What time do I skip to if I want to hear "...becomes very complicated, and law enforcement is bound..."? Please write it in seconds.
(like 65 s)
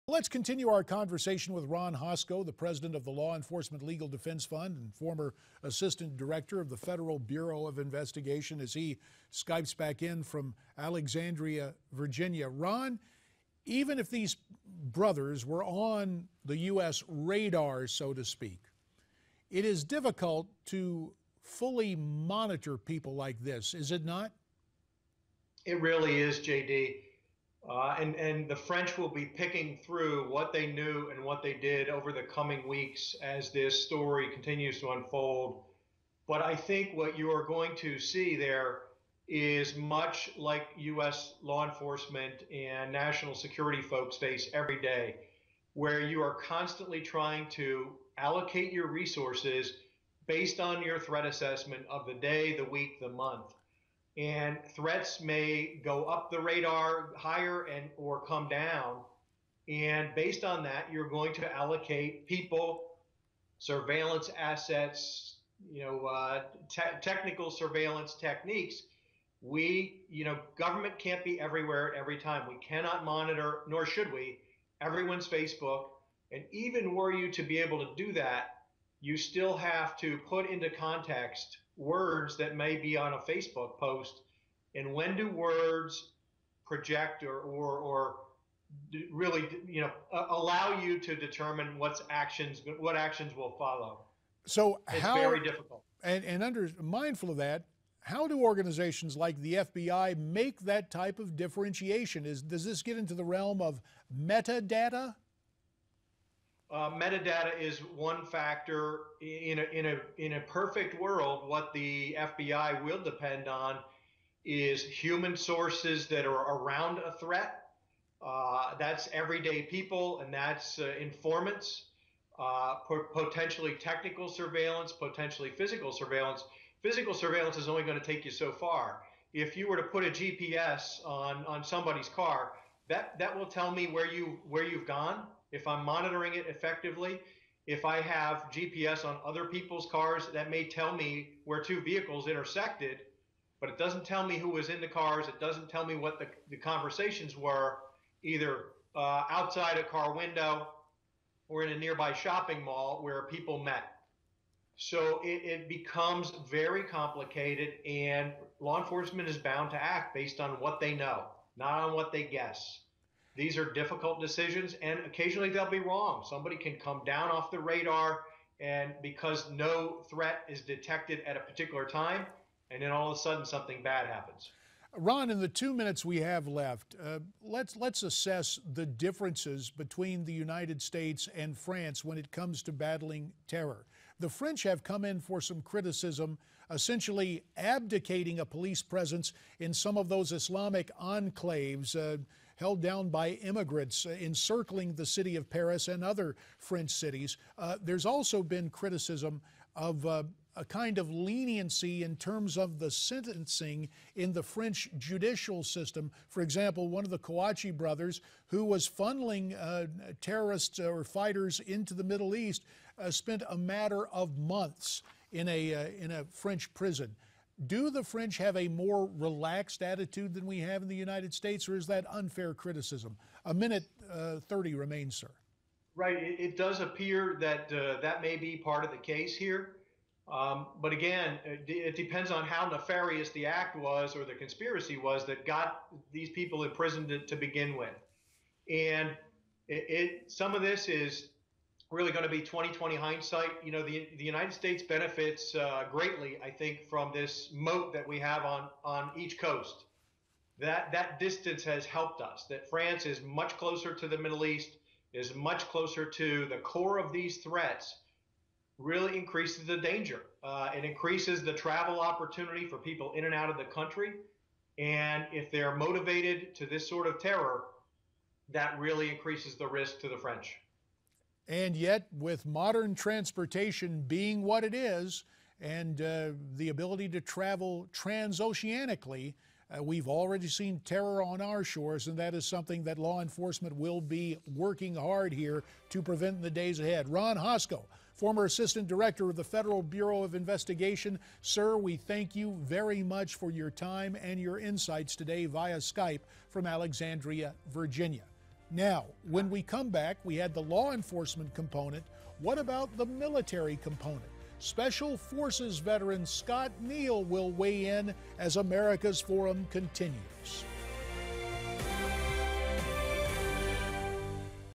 155 s.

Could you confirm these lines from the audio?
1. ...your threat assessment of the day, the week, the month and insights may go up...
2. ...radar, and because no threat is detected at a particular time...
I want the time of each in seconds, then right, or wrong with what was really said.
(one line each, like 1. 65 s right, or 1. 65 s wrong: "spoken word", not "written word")
1. 50 s wrong: "threats", not "insights"
2. 167 s right.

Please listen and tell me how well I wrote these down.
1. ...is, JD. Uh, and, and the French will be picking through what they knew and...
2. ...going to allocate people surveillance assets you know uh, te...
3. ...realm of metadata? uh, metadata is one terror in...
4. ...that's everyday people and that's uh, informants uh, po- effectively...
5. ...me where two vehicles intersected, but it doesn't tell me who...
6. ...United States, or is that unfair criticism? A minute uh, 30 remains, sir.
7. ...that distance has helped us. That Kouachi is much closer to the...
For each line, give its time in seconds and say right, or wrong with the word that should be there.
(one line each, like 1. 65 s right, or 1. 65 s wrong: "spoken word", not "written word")
1. 26 s right
2. 61 s right
3. 103 s wrong: "factor", not "terror"
4. 118 s wrong: "potentially", not "effectively"
5. 140 s right
6. 220 s right
7. 250 s wrong: "France", not "Kouachi".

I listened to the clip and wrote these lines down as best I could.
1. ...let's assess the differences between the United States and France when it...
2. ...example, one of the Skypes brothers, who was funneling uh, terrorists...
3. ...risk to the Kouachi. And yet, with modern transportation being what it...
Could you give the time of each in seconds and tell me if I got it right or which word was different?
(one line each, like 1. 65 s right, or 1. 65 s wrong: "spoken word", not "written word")
1. 177 s right
2. 206 s wrong: "Kouachi", not "Skypes"
3. 269 s wrong: "French", not "Kouachi".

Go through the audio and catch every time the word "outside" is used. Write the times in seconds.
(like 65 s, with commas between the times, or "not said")
149 s.